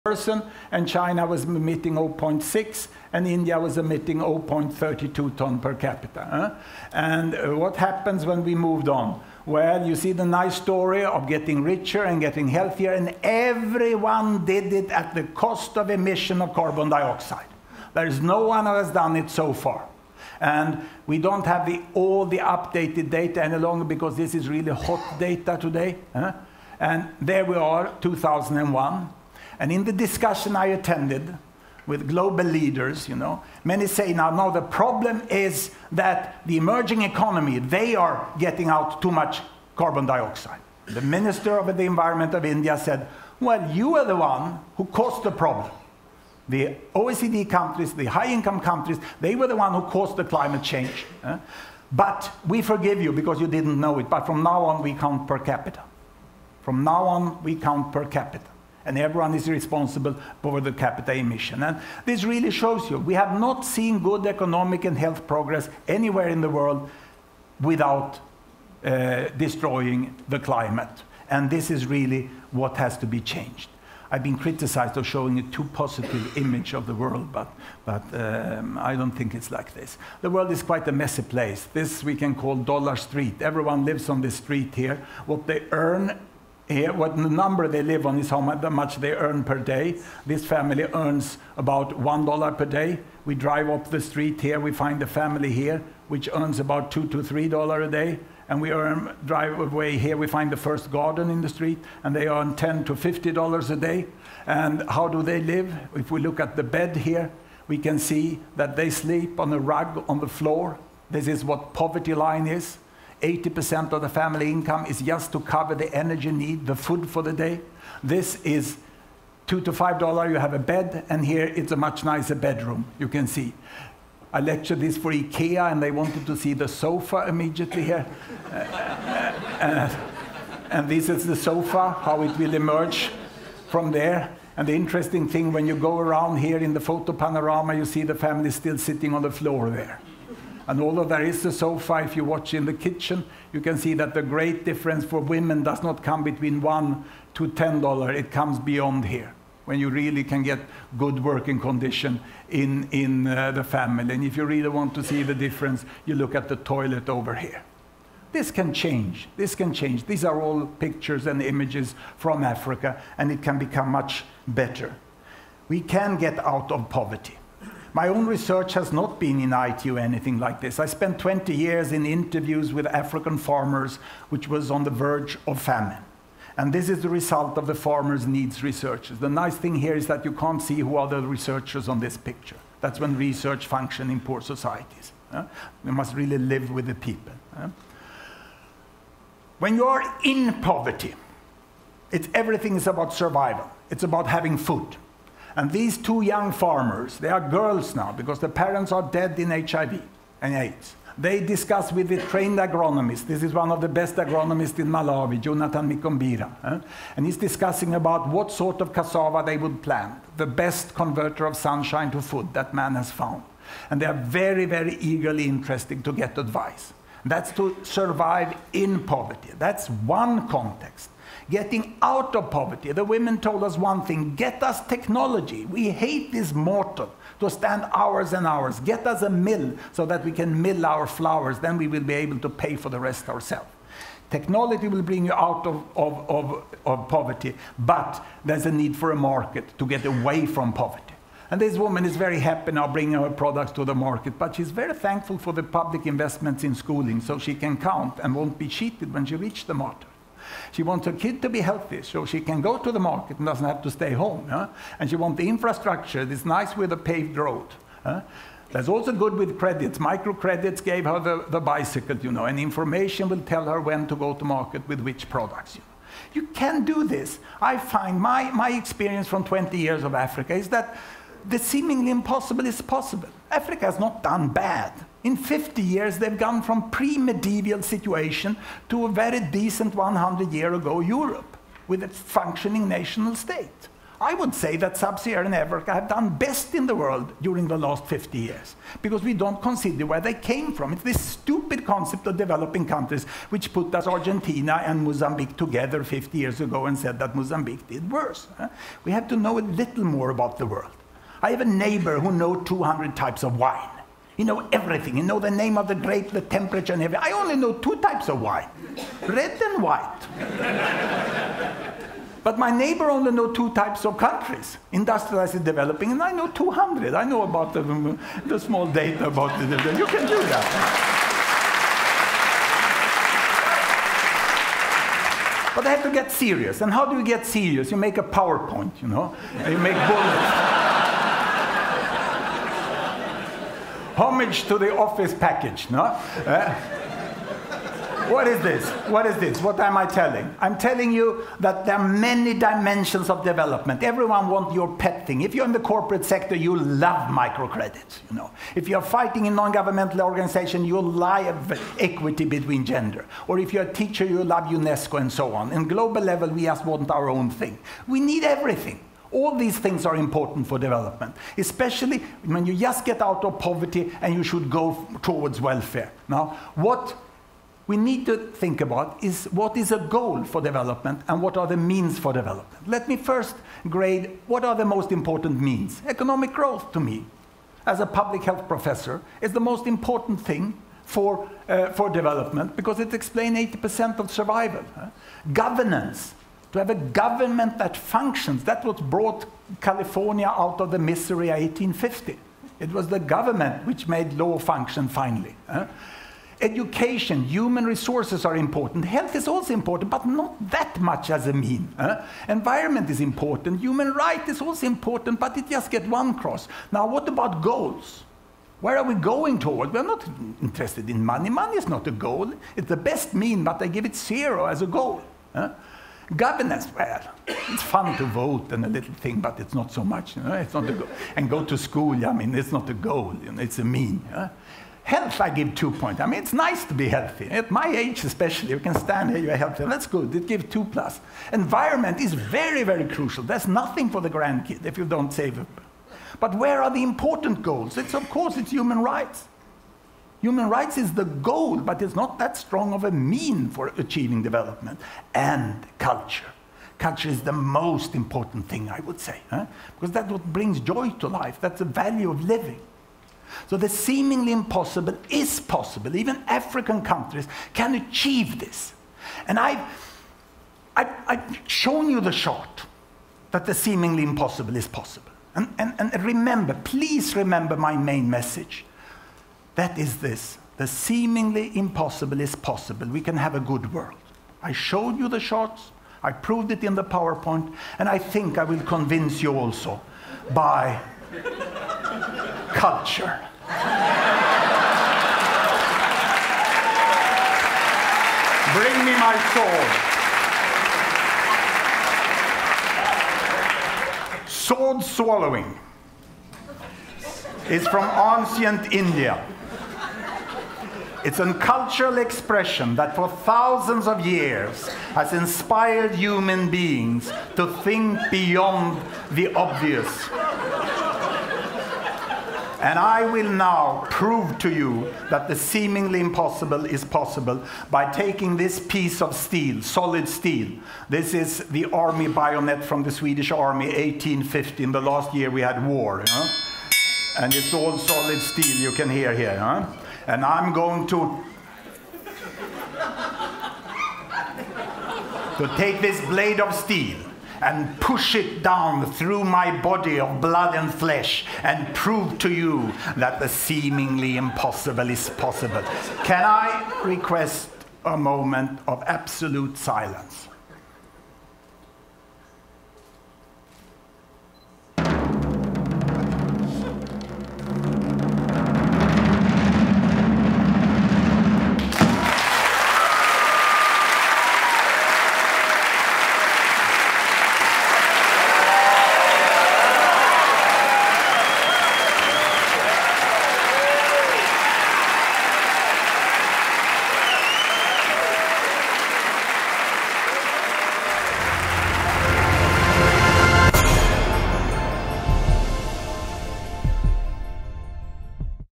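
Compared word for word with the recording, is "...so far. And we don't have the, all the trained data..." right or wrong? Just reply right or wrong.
wrong.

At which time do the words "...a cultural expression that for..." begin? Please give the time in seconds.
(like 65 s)
501 s.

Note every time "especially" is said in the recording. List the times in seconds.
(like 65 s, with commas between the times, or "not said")
361 s, 428 s.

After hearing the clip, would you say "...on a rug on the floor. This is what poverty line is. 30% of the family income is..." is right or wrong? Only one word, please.
wrong.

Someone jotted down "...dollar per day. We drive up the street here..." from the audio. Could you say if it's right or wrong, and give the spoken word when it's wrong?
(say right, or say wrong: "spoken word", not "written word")
right.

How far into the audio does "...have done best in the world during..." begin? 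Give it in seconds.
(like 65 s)
285 s.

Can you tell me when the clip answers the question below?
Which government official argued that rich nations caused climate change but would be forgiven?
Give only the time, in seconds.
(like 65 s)
41 s.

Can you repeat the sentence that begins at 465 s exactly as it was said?
And, and, and remember, please remember my main message that is this the seemingly impossible is possible.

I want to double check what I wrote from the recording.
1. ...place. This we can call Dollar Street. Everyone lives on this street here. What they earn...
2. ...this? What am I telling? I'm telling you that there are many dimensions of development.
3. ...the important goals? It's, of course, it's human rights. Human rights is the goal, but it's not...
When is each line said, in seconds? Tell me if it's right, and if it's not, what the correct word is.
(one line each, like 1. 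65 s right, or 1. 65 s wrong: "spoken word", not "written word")
1. 81 s right
2. 339 s right
3. 436 s right.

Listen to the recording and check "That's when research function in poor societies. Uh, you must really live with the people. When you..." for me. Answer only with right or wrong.
right.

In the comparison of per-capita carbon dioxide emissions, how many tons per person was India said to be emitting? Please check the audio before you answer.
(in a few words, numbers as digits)
0.32.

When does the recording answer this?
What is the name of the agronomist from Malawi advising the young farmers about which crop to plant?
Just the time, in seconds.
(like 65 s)
205 s.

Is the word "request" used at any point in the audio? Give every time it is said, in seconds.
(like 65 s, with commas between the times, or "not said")
547 s.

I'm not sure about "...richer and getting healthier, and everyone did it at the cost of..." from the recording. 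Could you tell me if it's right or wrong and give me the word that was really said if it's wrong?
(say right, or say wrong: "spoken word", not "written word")
right.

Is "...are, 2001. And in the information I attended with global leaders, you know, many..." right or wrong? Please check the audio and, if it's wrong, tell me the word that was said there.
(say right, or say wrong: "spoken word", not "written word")
wrong: "discussion", not "information".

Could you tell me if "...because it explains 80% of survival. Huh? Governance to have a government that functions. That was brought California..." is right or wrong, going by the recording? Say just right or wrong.
right.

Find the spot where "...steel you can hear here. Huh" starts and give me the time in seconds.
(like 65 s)
528 s.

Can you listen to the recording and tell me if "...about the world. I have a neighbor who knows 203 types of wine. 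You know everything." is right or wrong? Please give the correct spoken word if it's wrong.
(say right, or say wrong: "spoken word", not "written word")
wrong: "200", not "203".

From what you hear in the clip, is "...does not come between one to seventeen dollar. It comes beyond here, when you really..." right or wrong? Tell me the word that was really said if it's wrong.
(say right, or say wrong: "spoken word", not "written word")
wrong: "ten", not "seventeen".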